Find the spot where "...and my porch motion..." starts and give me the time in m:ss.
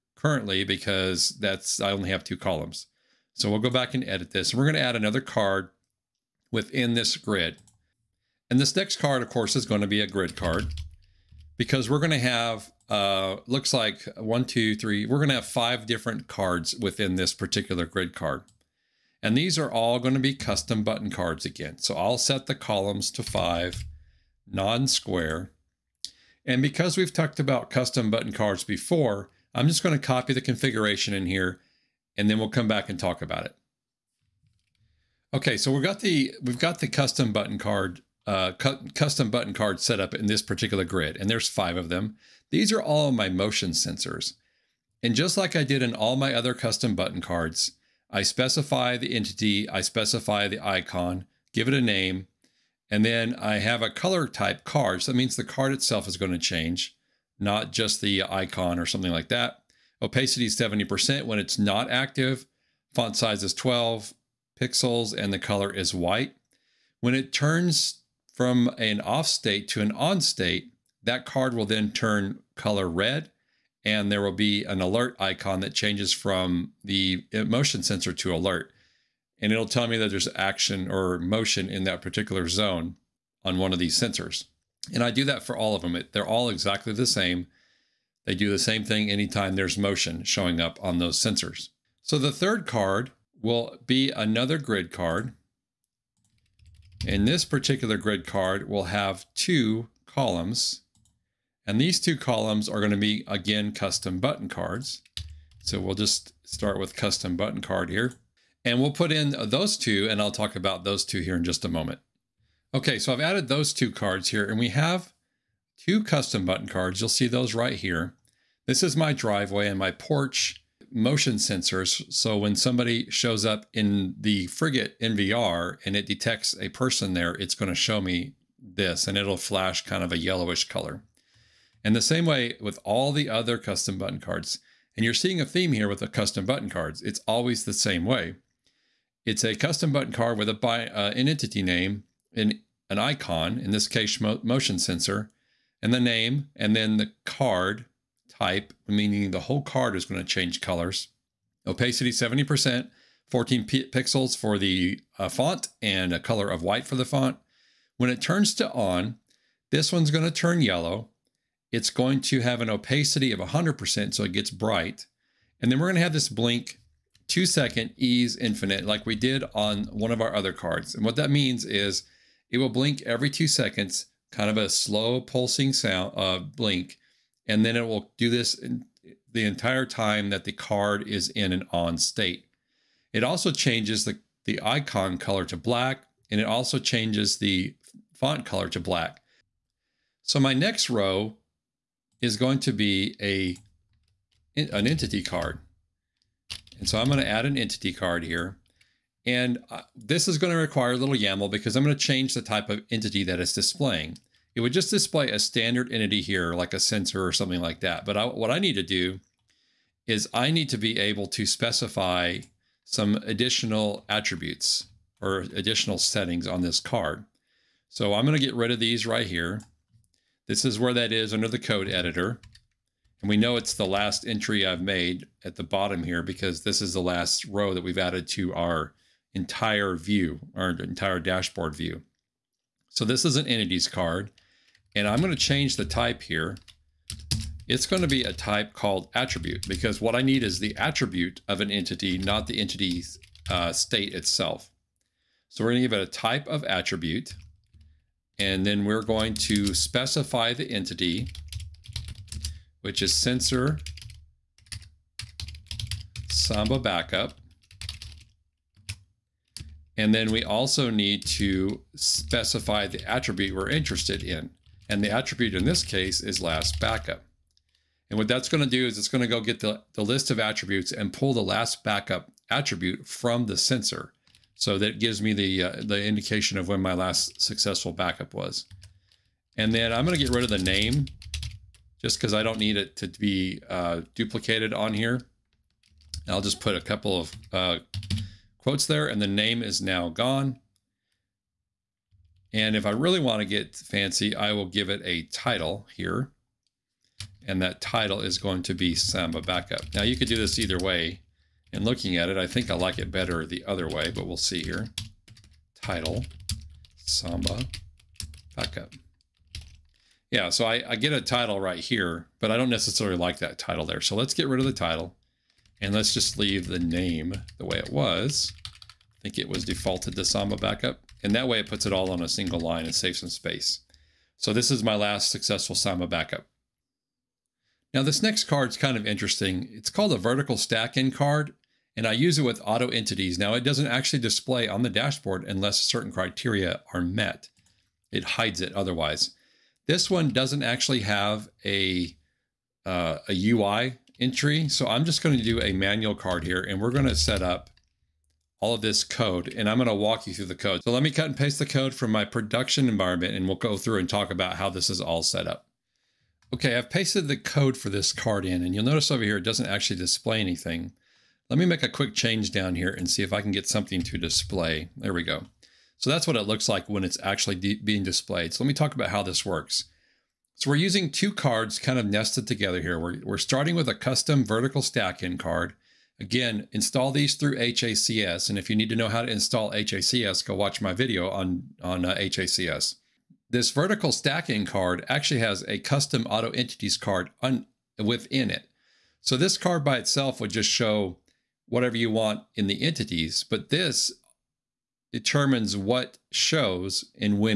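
1:59.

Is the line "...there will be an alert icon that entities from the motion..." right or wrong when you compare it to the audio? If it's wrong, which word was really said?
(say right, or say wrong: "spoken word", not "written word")
wrong: "changes", not "entities".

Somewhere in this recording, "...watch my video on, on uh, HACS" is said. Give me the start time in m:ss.
6:20.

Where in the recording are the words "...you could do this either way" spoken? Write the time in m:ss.
5:00.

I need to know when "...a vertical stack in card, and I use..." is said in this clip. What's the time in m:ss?
5:30.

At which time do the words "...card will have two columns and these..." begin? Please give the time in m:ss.
1:38.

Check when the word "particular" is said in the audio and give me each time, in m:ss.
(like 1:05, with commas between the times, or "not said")
0:17, 0:40, 1:22, 1:37.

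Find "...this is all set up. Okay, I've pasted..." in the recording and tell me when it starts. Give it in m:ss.
5:54.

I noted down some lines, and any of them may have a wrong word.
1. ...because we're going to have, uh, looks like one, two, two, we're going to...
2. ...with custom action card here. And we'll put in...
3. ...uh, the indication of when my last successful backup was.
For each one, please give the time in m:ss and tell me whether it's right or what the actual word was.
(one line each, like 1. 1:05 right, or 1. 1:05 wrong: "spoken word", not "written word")
1. 0:11 wrong: "three", not "two"
2. 1:46 wrong: "button", not "action"
3. 4:35 right.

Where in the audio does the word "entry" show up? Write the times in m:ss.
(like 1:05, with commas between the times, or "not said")
3:44, 5:44.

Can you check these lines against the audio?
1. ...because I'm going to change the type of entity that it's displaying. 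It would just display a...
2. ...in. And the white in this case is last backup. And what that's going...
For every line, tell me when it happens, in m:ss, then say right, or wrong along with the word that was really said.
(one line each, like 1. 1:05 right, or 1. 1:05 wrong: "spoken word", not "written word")
1. 3:21 right
2. 4:24 wrong: "attribute", not "white".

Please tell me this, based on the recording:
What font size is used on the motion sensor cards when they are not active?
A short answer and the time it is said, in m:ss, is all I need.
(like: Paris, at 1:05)
12 pixels, at 1:03.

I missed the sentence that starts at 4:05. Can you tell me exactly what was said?
So we're going to give it a type of attribute.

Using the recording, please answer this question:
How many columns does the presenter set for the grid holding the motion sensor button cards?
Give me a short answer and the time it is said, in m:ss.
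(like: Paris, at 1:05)
5, at 0:22.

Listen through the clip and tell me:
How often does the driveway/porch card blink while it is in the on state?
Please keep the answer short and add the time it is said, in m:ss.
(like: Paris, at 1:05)
every two seconds, at 2:53.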